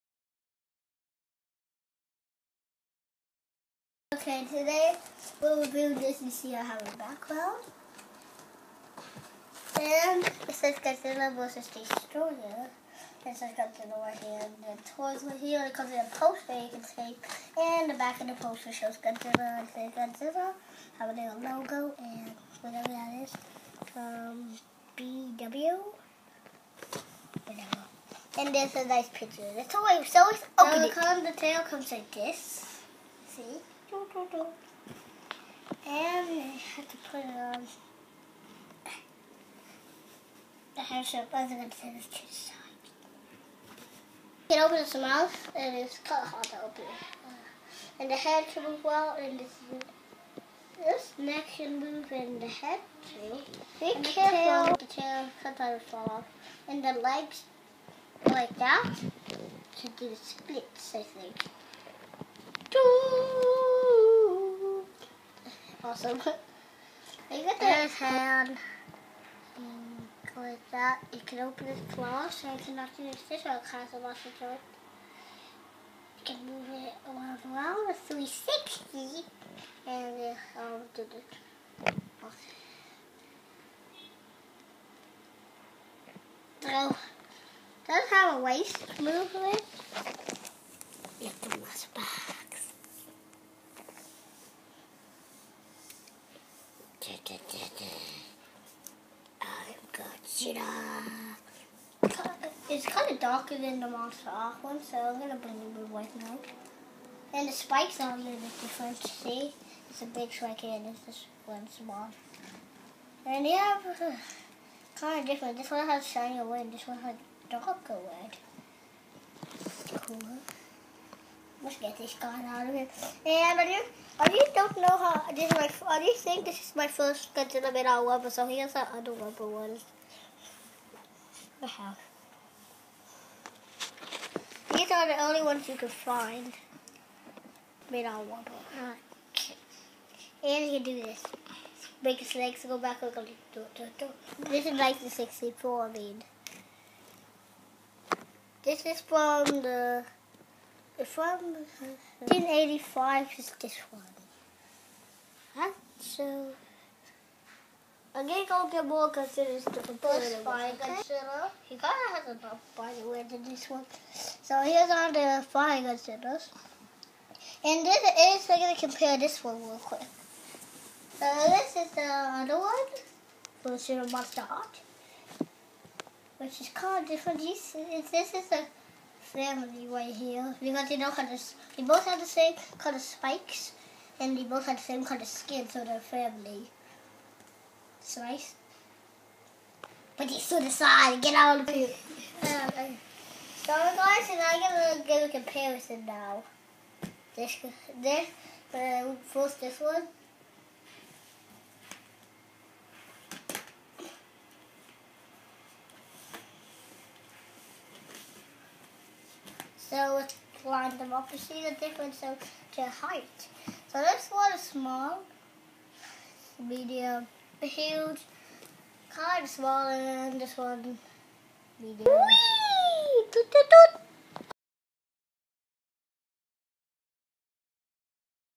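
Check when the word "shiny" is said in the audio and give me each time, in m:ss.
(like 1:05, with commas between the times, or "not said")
1:56.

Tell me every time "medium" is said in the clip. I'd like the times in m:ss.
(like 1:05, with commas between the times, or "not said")
3:36, 3:41.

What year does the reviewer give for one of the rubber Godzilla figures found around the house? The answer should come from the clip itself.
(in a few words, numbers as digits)
1985.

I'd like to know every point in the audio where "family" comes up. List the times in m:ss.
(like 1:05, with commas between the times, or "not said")
2:59, 3:05.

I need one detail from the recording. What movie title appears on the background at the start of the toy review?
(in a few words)
Godzilla vs. Destoroyah.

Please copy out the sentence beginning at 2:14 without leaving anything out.
These are the only ones you could find.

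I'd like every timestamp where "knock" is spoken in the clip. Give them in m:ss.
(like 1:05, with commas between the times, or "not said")
1:12.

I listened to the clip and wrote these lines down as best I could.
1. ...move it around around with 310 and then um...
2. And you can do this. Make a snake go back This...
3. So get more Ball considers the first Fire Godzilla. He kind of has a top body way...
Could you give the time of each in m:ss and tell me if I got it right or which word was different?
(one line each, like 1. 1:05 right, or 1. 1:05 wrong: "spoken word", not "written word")
1. 1:16 wrong: "360", not "310"
2. 2:20 right
3. 2:35 right.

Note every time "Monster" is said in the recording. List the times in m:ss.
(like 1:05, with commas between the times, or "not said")
1:43, 2:54.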